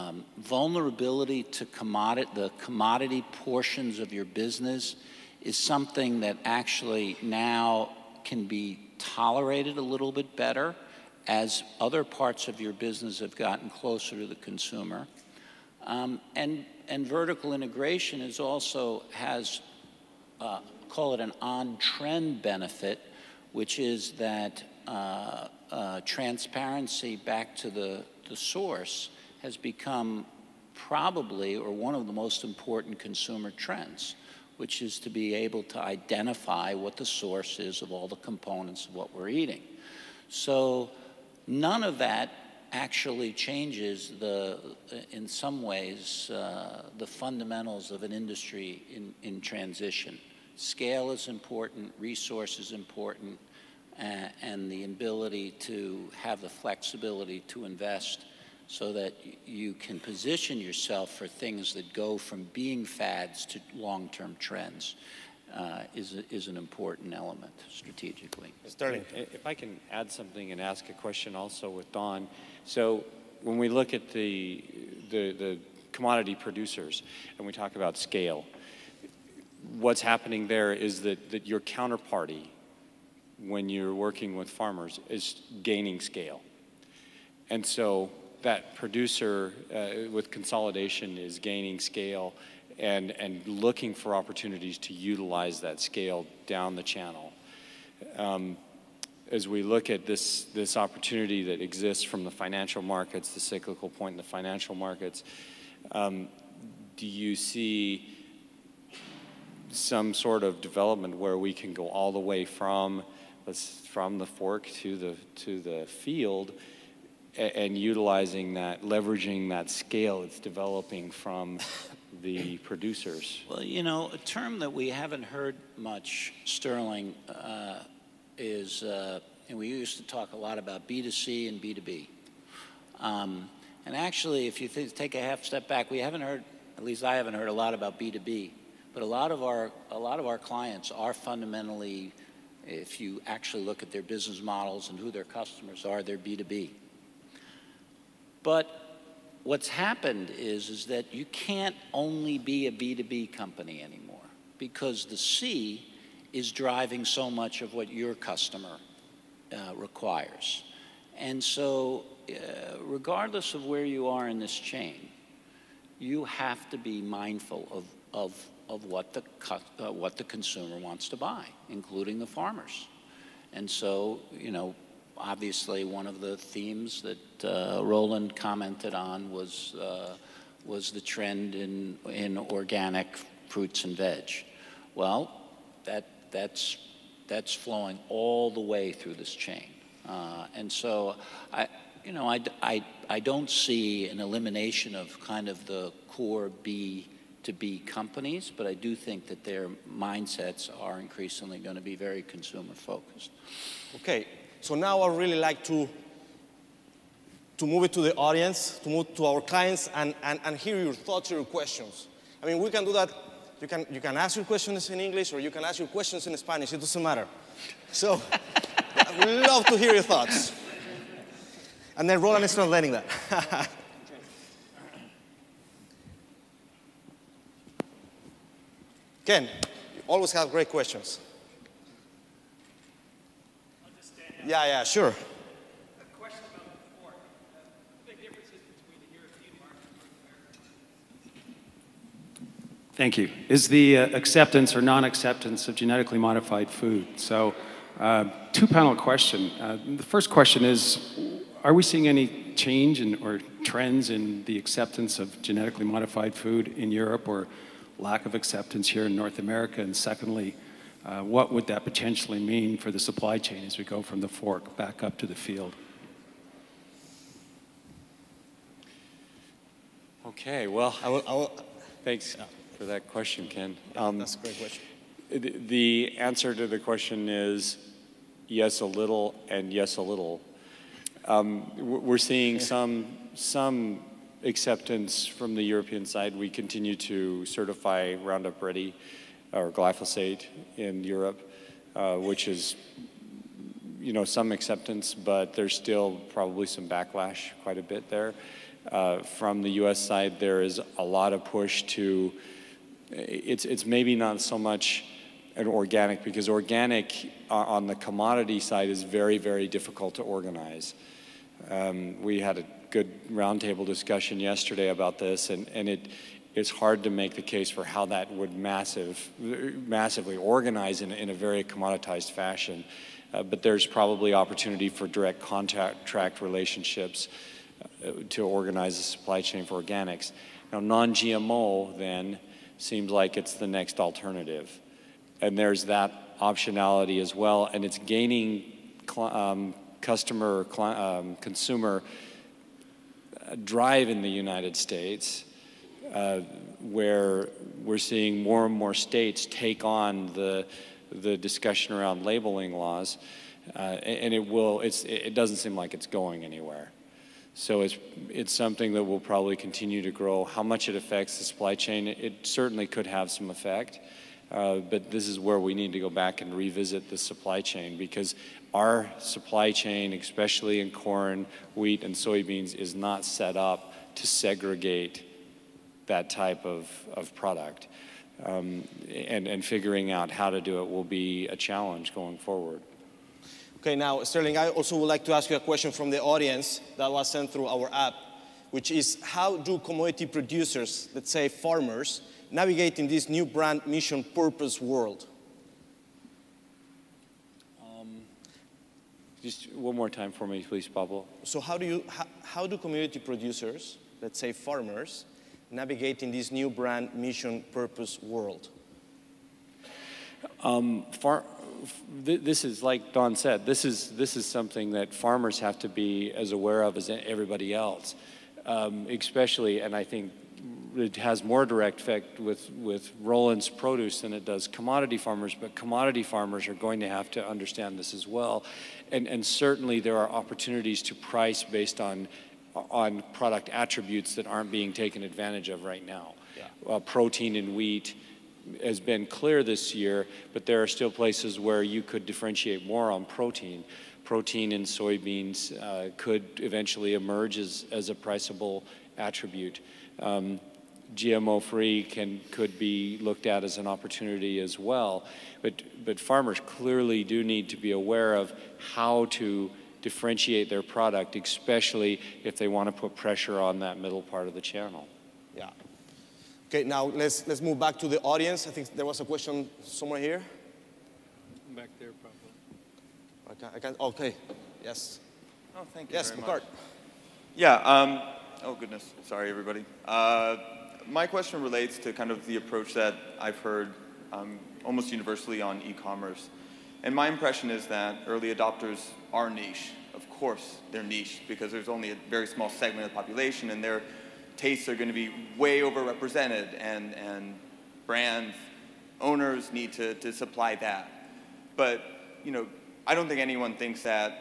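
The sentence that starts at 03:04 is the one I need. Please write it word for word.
Well, that that's that's flowing all the way through this chain, uh, and so I.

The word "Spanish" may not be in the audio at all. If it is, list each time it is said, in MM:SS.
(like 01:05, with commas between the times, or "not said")
03:36.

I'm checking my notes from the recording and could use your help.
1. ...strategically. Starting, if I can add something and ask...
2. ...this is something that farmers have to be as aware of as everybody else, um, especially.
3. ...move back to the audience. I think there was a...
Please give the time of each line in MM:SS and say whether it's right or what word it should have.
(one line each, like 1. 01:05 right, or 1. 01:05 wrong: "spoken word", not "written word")
1. 01:07 right
2. 06:54 right
3. 07:47 right.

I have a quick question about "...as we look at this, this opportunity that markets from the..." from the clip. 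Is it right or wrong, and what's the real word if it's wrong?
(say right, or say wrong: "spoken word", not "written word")
wrong: "exists", not "markets".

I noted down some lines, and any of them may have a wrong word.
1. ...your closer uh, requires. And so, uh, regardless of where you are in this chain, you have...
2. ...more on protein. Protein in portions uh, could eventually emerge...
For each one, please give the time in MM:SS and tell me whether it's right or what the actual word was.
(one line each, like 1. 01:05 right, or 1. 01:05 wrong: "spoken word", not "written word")
1. 02:37 wrong: "customer", not "closer"
2. 07:22 wrong: "soybeans", not "portions".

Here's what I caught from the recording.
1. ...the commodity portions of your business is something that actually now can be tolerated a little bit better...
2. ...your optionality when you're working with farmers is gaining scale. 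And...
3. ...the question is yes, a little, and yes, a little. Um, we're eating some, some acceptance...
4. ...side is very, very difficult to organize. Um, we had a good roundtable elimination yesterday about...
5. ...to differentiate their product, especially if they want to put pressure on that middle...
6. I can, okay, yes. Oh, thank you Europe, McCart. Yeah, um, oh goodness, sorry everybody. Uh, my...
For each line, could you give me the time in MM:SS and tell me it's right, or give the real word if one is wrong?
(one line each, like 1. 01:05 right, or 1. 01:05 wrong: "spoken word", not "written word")
1. 00:02 right
2. 01:21 wrong: "counterparty", not "optionality"
3. 04:36 wrong: "seeing", not "eating"
4. 05:08 wrong: "discussion", not "elimination"
5. 07:39 right
6. 07:53 wrong: "Yes", not "Europe".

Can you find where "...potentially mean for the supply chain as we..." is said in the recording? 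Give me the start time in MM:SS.
04:21.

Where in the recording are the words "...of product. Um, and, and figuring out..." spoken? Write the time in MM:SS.
06:17.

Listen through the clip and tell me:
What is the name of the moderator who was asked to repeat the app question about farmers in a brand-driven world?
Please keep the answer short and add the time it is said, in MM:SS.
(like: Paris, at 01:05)
Pablo, at 06:40.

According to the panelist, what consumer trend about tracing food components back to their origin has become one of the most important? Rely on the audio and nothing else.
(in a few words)
transparency.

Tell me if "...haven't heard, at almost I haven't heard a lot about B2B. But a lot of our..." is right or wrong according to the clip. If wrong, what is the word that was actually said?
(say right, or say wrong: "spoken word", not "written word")
wrong: "least", not "almost".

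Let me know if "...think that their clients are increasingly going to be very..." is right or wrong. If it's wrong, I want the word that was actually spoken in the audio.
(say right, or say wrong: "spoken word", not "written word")
wrong: "mindsets", not "clients".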